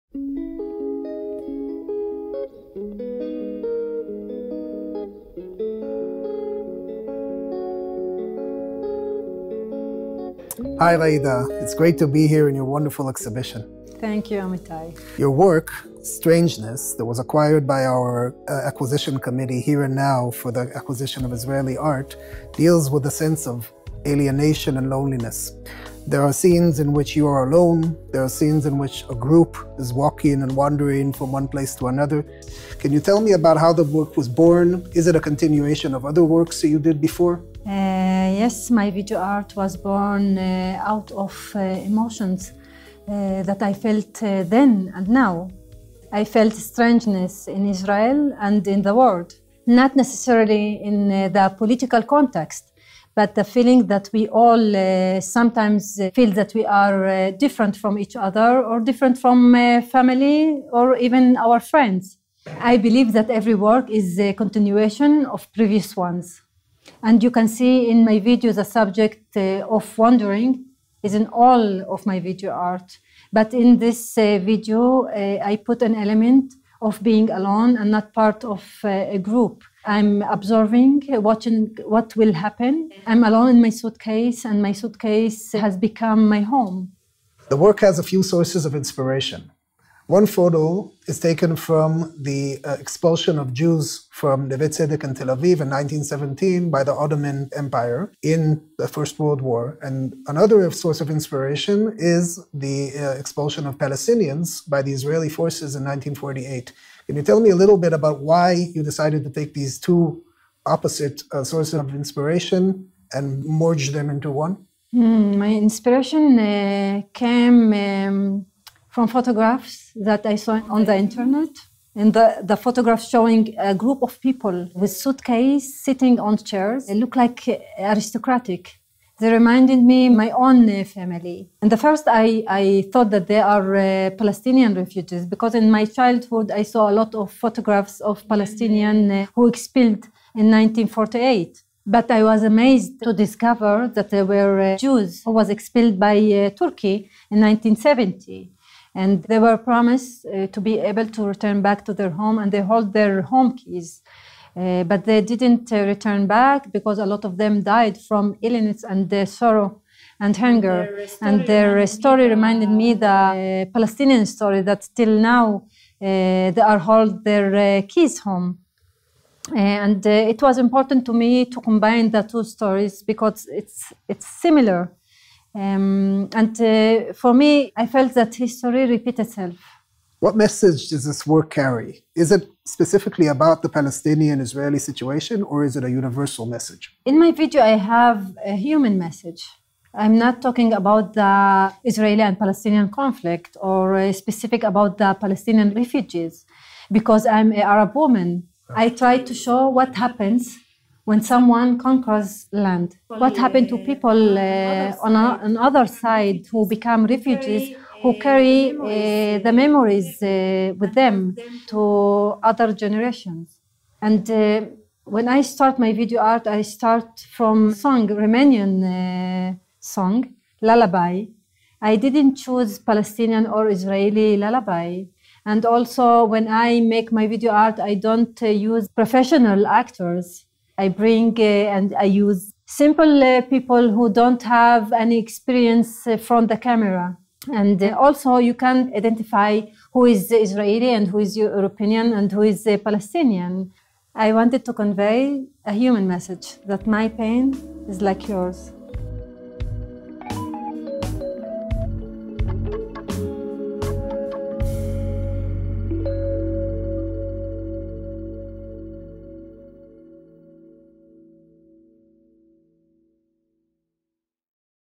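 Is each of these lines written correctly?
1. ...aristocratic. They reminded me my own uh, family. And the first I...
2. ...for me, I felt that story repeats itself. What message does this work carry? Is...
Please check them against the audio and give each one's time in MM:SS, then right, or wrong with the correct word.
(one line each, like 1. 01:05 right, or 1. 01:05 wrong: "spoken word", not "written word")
1. 02:07 right
2. 02:57 wrong: "history", not "story".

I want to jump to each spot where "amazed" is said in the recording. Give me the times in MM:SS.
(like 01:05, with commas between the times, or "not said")
02:22.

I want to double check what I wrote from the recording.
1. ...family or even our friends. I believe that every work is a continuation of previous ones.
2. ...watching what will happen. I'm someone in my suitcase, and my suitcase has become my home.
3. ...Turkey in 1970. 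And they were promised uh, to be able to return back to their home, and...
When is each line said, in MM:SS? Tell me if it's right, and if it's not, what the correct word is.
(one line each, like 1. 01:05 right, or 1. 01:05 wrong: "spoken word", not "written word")
1. 00:59 right
2. 01:21 wrong: "alone", not "someone"
3. 02:26 right.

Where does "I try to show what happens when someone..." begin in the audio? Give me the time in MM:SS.
03:18.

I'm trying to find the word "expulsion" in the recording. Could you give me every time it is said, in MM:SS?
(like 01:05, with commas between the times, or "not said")
01:32, 01:43.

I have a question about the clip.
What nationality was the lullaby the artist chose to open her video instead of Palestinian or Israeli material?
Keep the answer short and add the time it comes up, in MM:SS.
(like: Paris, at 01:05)
Romanian, at 03:38.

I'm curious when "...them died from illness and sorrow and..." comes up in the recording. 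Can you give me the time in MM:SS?
02:37.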